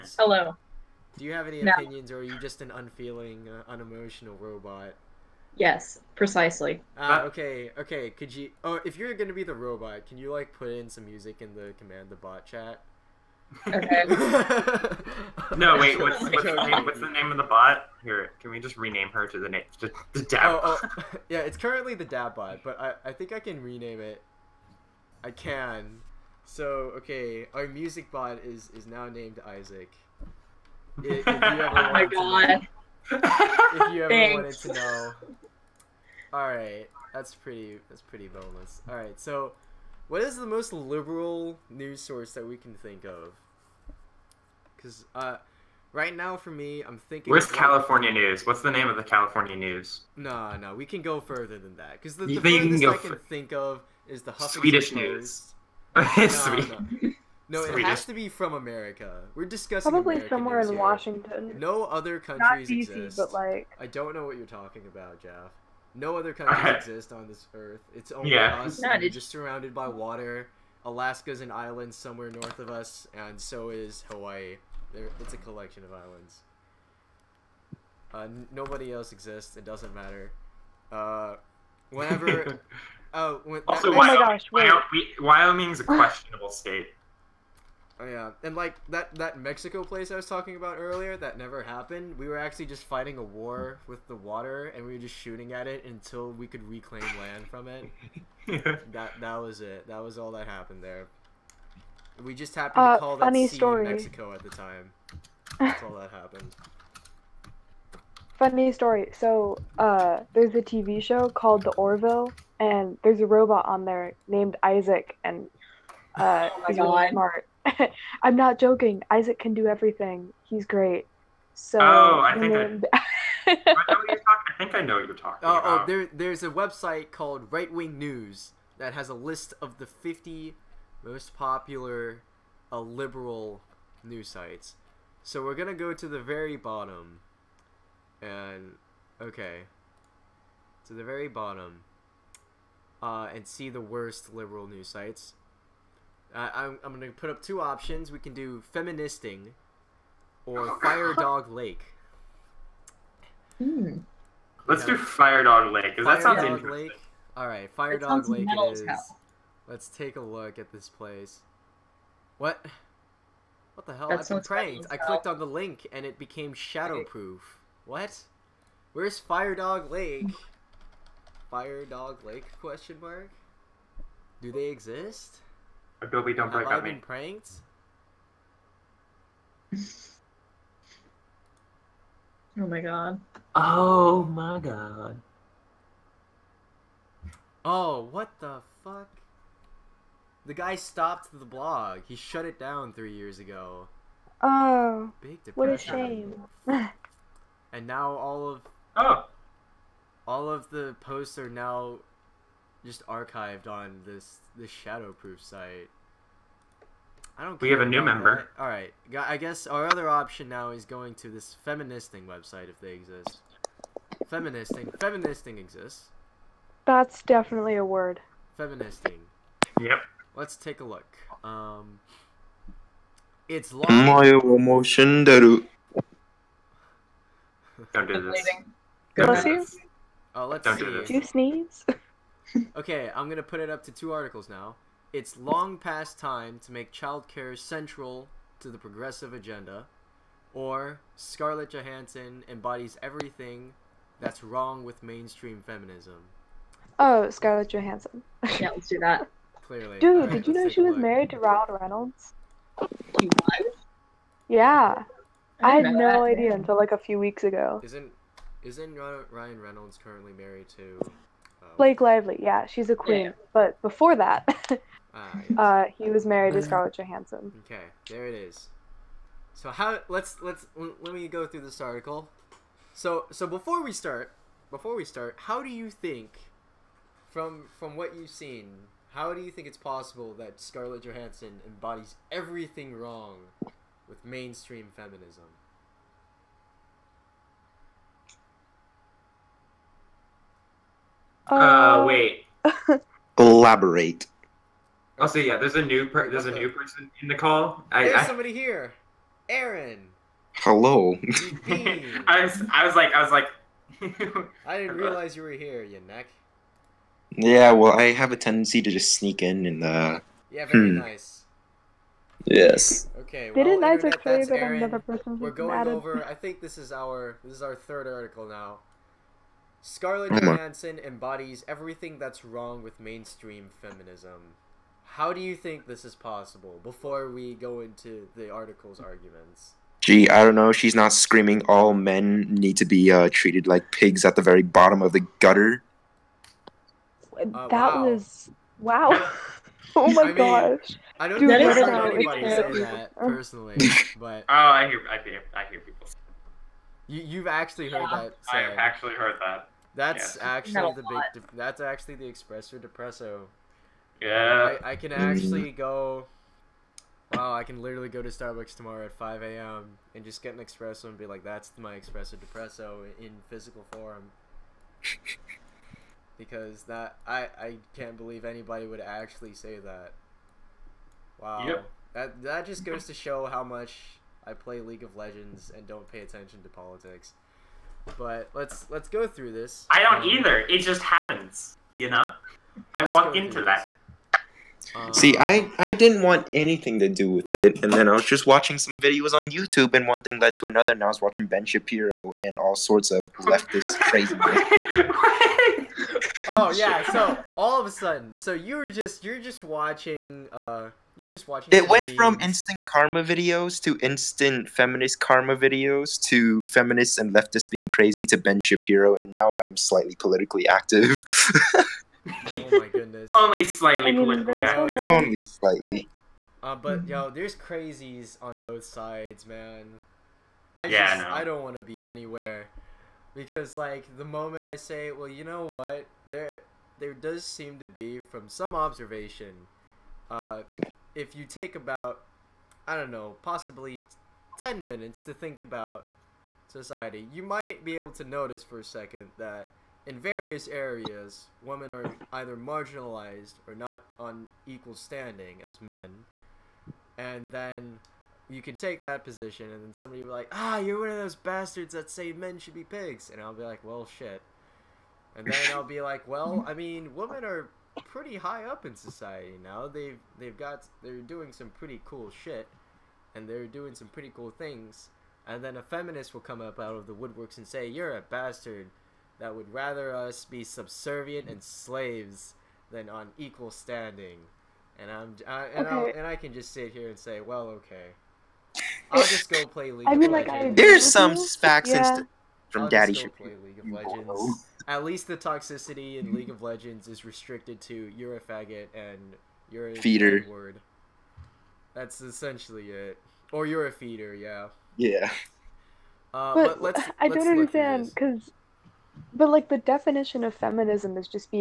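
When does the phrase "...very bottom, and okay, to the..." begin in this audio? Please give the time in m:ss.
2:16.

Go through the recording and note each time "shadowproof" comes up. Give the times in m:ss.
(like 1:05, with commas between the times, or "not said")
2:46, 3:24.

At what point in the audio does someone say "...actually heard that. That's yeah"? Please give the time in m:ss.
5:48.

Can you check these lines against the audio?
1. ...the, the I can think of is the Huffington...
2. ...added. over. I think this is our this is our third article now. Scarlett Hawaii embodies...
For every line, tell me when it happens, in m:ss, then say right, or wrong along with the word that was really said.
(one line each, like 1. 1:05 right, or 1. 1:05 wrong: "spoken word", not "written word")
1. 0:52 right
2. 5:15 wrong: "Johansson", not "Hawaii".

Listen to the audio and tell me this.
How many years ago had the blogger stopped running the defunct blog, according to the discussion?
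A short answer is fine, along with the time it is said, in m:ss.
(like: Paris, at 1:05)
3, at 3:12.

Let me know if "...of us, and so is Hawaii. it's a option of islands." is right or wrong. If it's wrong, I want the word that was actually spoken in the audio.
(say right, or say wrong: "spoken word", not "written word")
wrong: "collection", not "option".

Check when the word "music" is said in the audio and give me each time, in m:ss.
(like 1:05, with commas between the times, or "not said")
0:11, 0:27.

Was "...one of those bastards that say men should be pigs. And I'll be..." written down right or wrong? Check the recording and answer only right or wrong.
right.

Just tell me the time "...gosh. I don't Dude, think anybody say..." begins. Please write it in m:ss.
5:40.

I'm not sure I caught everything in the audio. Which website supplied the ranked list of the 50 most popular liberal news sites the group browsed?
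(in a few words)
Right Wing News.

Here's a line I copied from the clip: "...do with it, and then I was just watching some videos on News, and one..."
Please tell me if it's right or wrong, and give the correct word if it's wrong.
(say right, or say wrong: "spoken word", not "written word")
wrong: "YouTube", not "News".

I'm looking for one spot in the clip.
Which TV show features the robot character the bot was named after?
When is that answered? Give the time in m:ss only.
1:51.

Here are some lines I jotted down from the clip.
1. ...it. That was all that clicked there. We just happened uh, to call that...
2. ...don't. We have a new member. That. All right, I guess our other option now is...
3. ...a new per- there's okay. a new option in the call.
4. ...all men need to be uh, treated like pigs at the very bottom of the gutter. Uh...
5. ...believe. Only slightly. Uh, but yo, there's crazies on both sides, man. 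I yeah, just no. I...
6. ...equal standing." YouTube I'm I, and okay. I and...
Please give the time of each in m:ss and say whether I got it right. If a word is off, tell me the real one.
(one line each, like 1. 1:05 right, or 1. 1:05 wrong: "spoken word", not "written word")
1. 1:39 wrong: "happened", not "clicked"
2. 3:27 right
3. 4:55 wrong: "person", not "option"
4. 5:31 right
5. 6:54 wrong: "active", not "believe"
6. 7:53 wrong: "And", not "YouTube".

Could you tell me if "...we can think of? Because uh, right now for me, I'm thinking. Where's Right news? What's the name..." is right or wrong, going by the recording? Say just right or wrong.
wrong.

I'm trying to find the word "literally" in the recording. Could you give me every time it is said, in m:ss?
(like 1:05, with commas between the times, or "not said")
5:57.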